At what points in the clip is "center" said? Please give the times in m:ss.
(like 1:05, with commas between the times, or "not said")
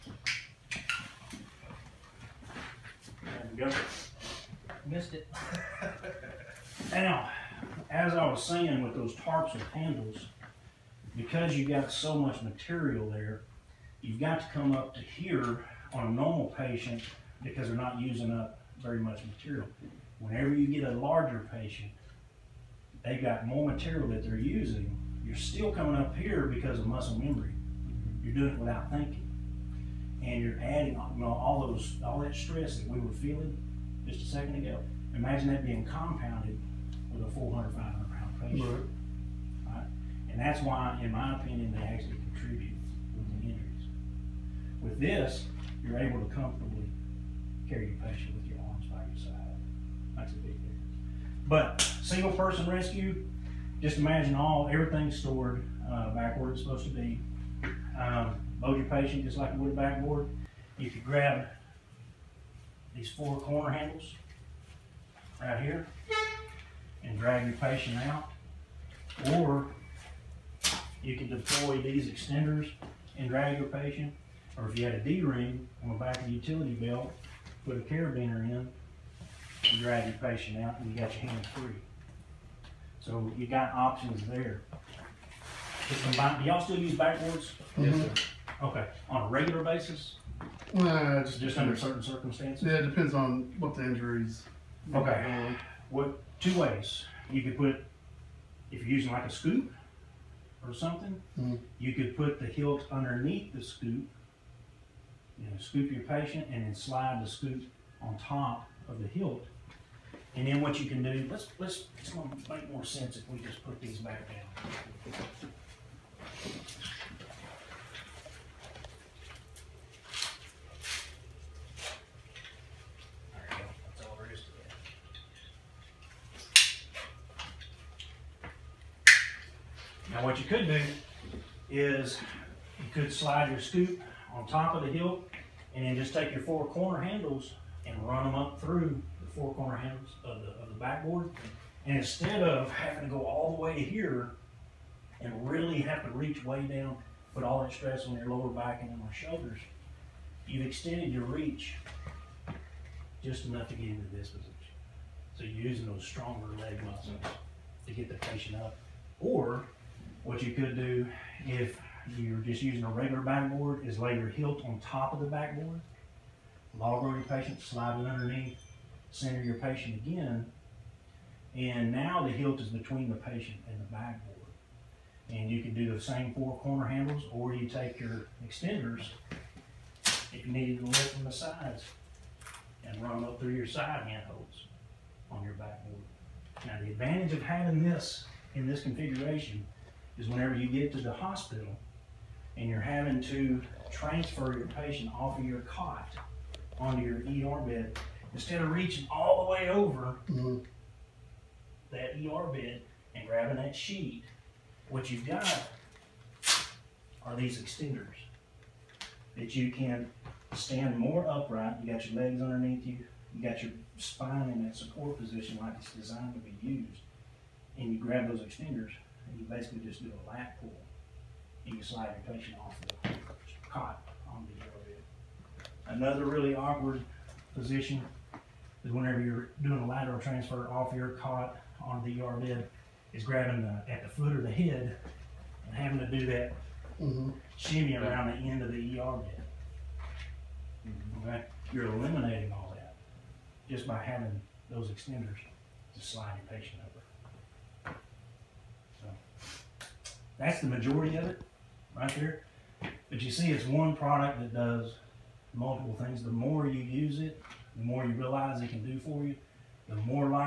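2:49.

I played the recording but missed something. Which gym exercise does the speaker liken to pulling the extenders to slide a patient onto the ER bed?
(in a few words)
Lat pull.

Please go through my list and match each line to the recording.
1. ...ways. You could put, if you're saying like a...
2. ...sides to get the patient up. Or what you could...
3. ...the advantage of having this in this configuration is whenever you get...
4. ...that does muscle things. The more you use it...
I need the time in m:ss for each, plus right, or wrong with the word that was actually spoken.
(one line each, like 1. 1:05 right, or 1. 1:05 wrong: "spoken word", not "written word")
1. 1:36 wrong: "using", not "saying"
2. 2:36 wrong: "muscles", not "sides"
3. 3:06 right
4. 4:14 wrong: "multiple", not "muscle".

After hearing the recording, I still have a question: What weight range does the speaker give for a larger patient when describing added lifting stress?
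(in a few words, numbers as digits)
400, 500 pound.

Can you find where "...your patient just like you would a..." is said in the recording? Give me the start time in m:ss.
0:58.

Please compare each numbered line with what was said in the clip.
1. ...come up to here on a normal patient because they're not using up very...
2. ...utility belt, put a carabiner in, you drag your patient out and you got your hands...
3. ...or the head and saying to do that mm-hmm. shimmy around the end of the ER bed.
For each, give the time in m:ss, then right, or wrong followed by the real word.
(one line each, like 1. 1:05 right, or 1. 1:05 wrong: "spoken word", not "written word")
1. 0:14 right
2. 1:16 right
3. 3:54 wrong: "having", not "saying".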